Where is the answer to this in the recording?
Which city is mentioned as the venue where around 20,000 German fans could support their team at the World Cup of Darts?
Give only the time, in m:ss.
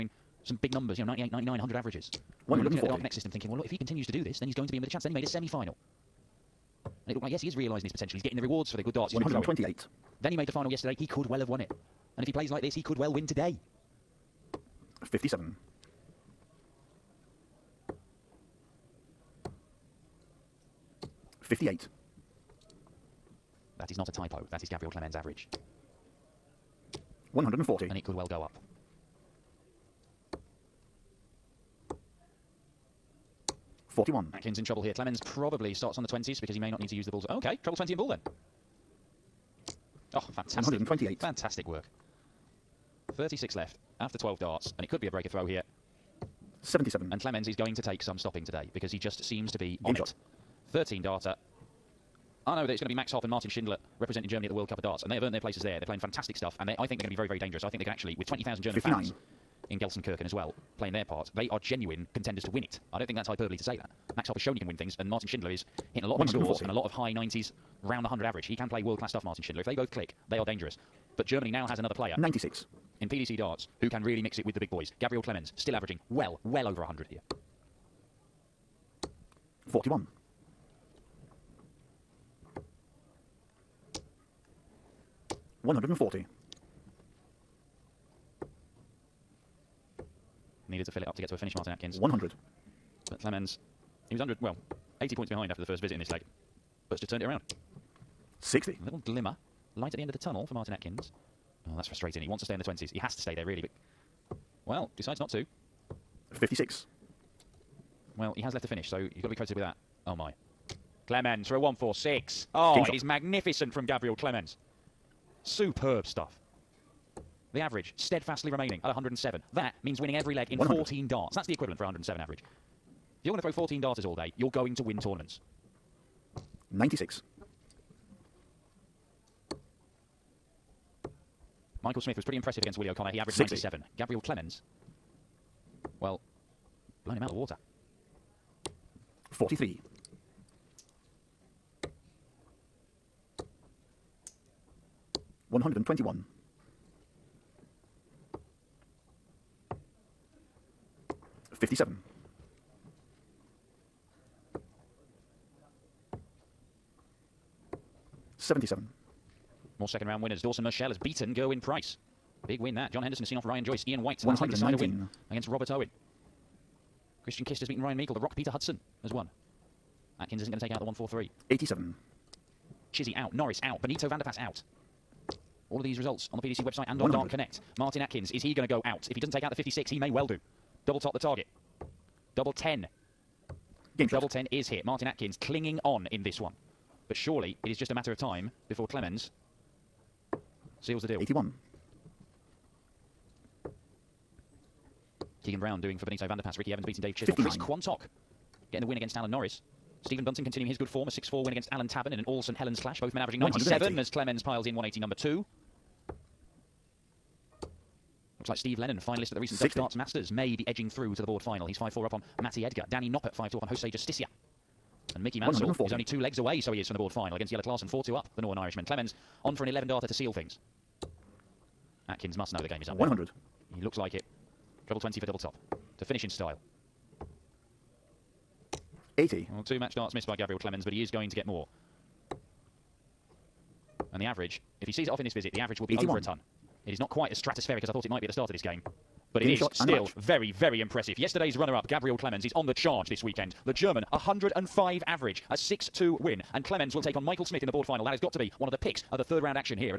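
0:59.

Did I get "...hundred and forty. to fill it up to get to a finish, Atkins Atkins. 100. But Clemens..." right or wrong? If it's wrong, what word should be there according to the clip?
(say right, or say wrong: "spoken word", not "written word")
wrong: "Martin", not "Atkins".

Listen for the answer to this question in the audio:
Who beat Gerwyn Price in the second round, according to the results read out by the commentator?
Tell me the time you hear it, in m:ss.
2:40.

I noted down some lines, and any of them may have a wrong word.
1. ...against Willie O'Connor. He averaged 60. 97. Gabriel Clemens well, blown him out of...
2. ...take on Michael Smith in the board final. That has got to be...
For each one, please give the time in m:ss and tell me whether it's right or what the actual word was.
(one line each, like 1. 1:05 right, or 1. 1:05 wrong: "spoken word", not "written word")
1. 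2:12 right
2. 4:07 right.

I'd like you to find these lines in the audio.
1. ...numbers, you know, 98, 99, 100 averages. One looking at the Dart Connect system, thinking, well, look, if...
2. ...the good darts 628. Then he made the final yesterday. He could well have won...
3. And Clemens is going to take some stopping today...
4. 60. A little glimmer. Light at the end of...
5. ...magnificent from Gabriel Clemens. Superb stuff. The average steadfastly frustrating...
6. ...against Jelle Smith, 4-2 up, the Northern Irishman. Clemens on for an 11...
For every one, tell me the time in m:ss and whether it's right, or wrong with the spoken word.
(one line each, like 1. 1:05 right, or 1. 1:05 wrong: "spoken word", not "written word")
1. 0:00 right
2. 0:08 wrong: "128", not "628"
3. 0:47 right
4. 1:38 right
5. 1:53 wrong: "remaining", not "frustrating"
6. 3:37 wrong: "Klaasen", not "Smith".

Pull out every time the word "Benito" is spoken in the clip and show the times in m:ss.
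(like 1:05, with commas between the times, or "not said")
2:53, 3:16.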